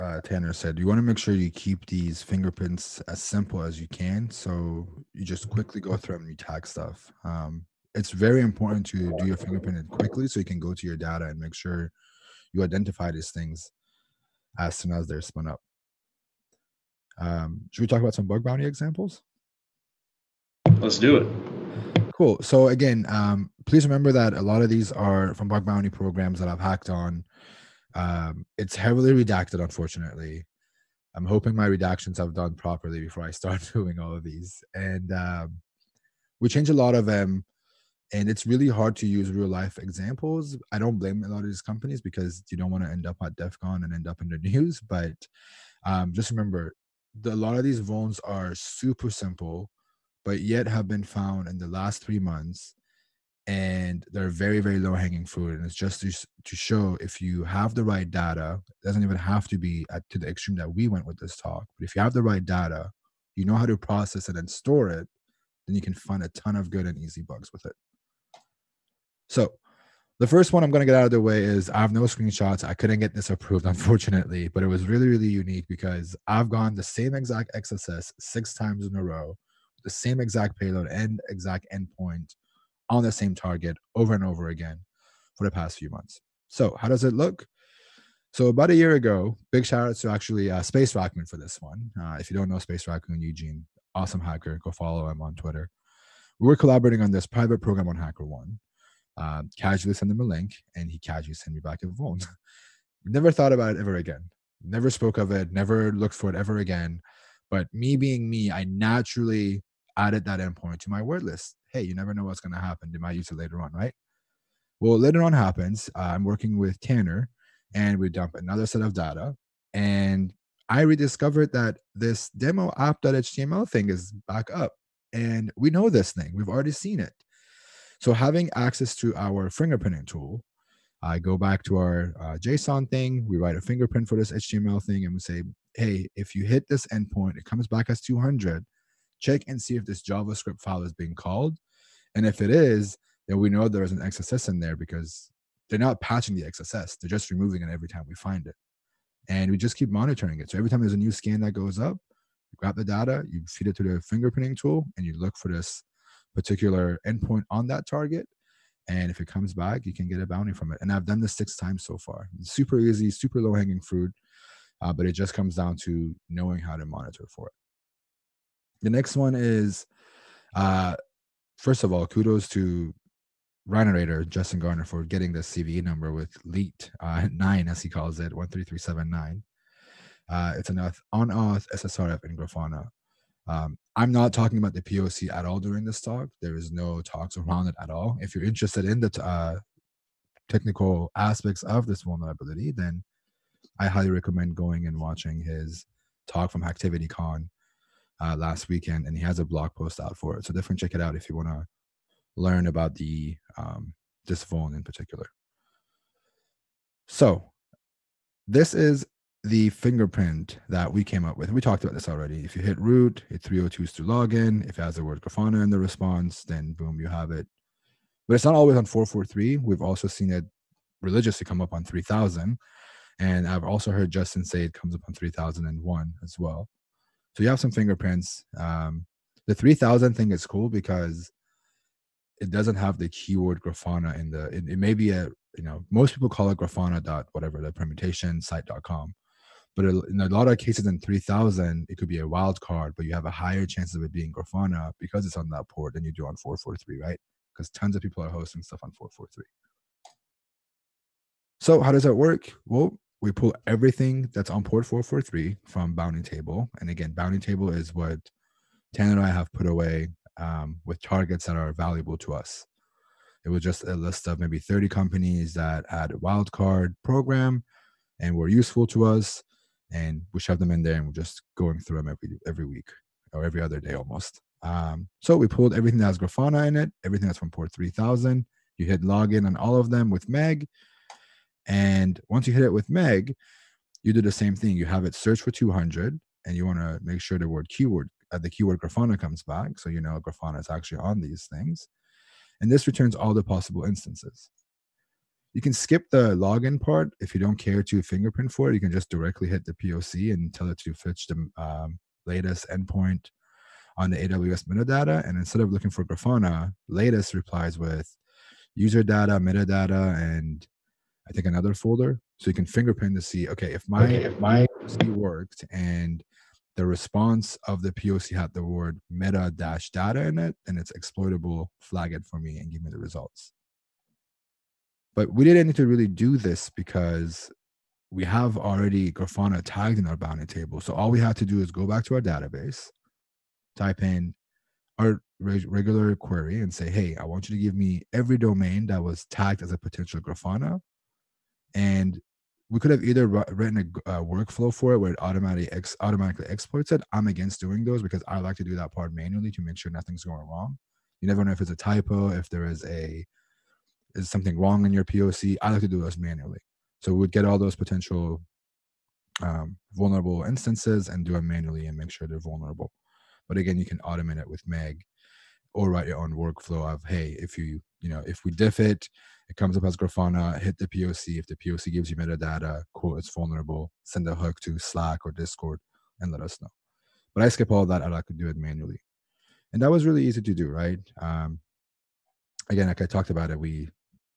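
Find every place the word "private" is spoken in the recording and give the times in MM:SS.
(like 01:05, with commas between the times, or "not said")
01:37.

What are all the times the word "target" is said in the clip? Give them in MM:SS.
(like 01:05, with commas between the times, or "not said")
01:23, 02:37, 04:21.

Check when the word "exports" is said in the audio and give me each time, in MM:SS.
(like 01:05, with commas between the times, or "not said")
05:46.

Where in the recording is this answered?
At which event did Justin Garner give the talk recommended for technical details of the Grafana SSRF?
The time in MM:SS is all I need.
03:16.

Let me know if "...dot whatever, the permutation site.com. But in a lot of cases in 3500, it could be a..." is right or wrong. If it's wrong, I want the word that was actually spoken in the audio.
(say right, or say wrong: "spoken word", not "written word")
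wrong: "3000", not "3500".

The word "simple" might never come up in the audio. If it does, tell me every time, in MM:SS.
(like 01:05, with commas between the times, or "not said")
00:03, 00:49.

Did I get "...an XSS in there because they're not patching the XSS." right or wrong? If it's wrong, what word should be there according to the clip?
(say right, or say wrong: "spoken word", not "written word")
right.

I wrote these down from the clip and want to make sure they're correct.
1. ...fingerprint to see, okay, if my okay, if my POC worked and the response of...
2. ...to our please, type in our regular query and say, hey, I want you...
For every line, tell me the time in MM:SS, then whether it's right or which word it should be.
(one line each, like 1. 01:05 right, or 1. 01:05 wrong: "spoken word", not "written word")
1. 05:12 right
2. 05:32 wrong: "database", not "please".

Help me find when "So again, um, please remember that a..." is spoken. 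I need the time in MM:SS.
00:22.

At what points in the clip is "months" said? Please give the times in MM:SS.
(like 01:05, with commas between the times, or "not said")
00:52, 01:25.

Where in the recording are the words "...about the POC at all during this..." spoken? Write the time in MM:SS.
03:04.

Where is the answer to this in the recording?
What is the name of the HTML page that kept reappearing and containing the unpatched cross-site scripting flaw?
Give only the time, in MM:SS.
02:02.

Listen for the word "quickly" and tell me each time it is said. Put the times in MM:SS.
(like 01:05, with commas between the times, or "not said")
00:05, 00:09.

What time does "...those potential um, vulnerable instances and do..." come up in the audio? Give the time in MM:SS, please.
05:57.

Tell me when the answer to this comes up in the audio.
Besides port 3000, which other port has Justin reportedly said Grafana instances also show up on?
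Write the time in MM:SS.
03:45.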